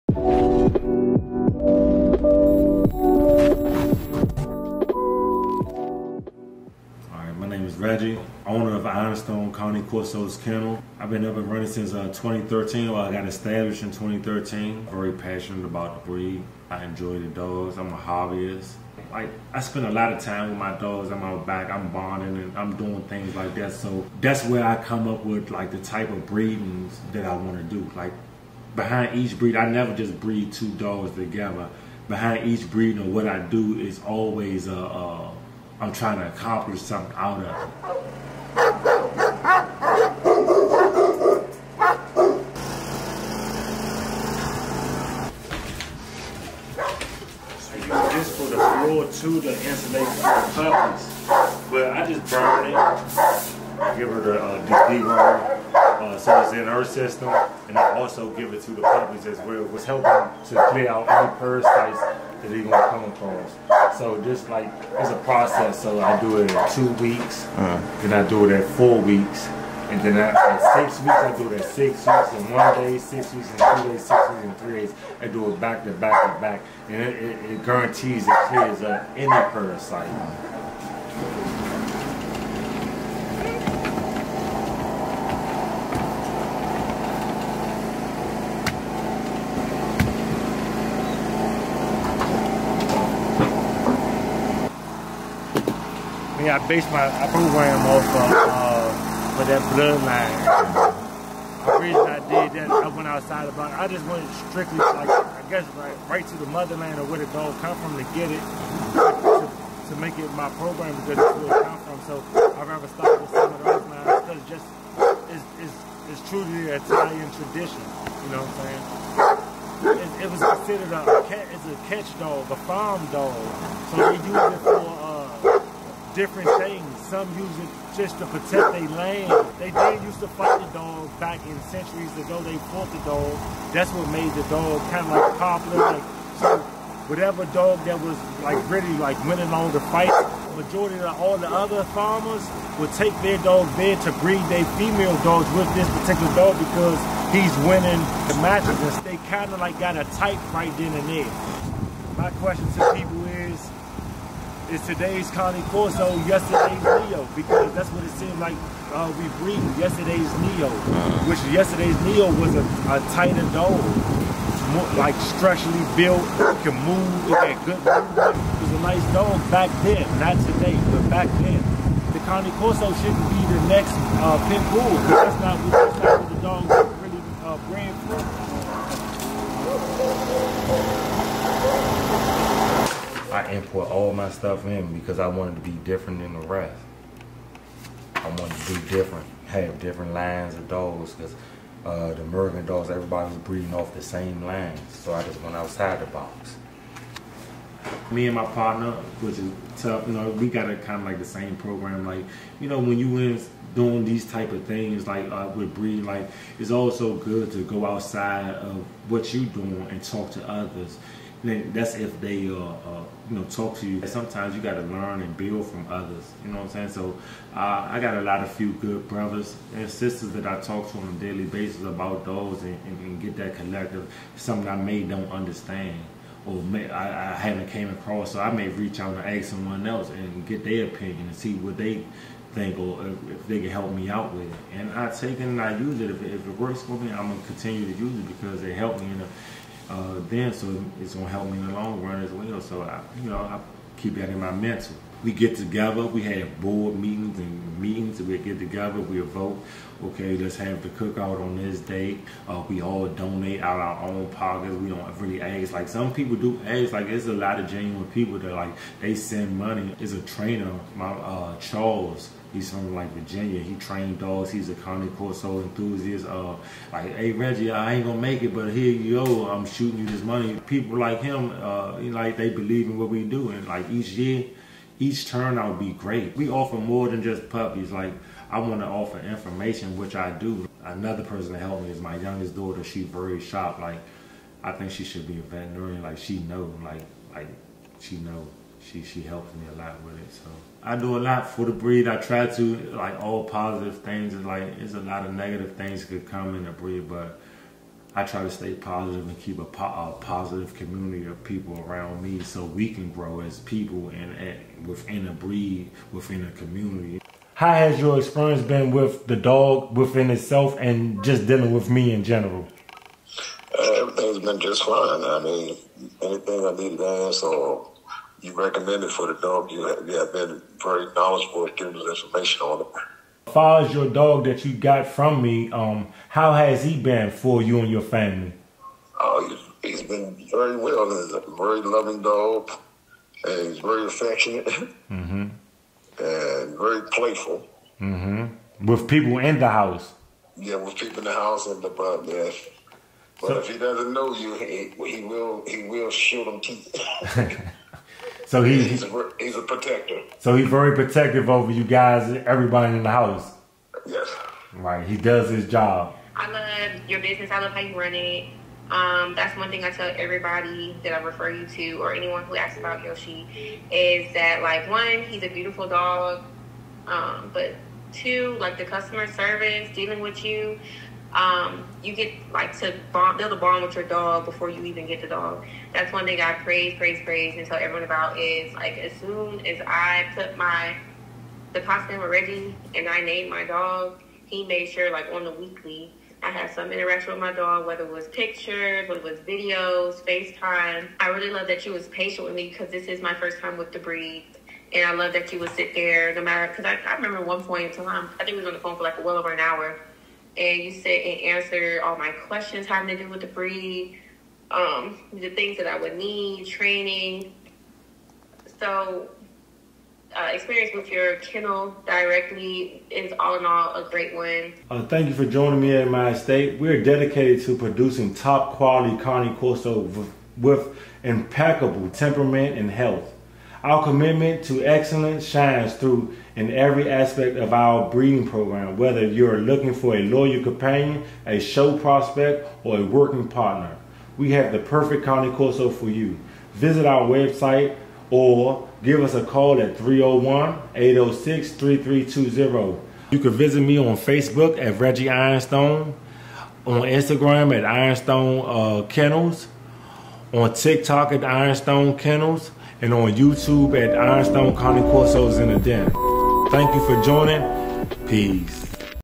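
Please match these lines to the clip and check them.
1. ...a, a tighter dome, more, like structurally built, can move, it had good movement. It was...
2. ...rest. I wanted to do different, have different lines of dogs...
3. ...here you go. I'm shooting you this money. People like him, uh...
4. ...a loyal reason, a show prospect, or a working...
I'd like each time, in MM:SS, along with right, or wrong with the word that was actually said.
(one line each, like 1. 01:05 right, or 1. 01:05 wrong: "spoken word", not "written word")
1. 02:42 right
2. 03:06 right
3. 04:28 right
4. 07:10 wrong: "companion", not "reason".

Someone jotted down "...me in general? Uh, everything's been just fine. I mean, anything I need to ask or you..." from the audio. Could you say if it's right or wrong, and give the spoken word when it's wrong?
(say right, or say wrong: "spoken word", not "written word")
right.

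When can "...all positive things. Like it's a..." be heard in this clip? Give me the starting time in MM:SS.
04:53.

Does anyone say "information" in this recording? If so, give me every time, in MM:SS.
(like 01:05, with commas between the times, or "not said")
04:39, 05:22.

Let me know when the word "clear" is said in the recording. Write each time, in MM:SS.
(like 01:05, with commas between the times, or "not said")
01:00, 01:18.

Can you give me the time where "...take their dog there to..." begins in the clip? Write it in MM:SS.
02:22.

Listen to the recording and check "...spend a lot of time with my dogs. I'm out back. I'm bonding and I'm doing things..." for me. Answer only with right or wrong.
right.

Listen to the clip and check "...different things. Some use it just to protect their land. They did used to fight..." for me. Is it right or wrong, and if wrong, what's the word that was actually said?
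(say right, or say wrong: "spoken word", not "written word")
right.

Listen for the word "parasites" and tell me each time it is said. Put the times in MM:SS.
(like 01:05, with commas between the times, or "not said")
01:01, 01:19.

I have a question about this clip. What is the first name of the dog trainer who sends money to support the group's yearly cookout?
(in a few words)
Charles.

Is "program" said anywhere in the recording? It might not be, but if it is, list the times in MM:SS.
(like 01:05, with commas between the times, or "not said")
01:37, 01:50, 03:21, 07:08.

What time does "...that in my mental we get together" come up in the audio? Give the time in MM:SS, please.
04:04.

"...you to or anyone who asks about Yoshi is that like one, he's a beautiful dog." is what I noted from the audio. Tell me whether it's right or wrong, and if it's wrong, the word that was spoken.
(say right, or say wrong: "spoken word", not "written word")
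right.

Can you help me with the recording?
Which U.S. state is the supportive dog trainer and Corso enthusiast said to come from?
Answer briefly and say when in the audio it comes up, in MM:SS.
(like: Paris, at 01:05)
Virginia, at 04:23.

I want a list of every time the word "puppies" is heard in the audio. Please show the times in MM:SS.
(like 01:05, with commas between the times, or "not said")
00:58, 04:37.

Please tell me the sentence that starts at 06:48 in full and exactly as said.
So, uh, experience with your kennel directly is all in all a great one.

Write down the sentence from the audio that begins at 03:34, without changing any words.
Sometimes you got to learn and build from others.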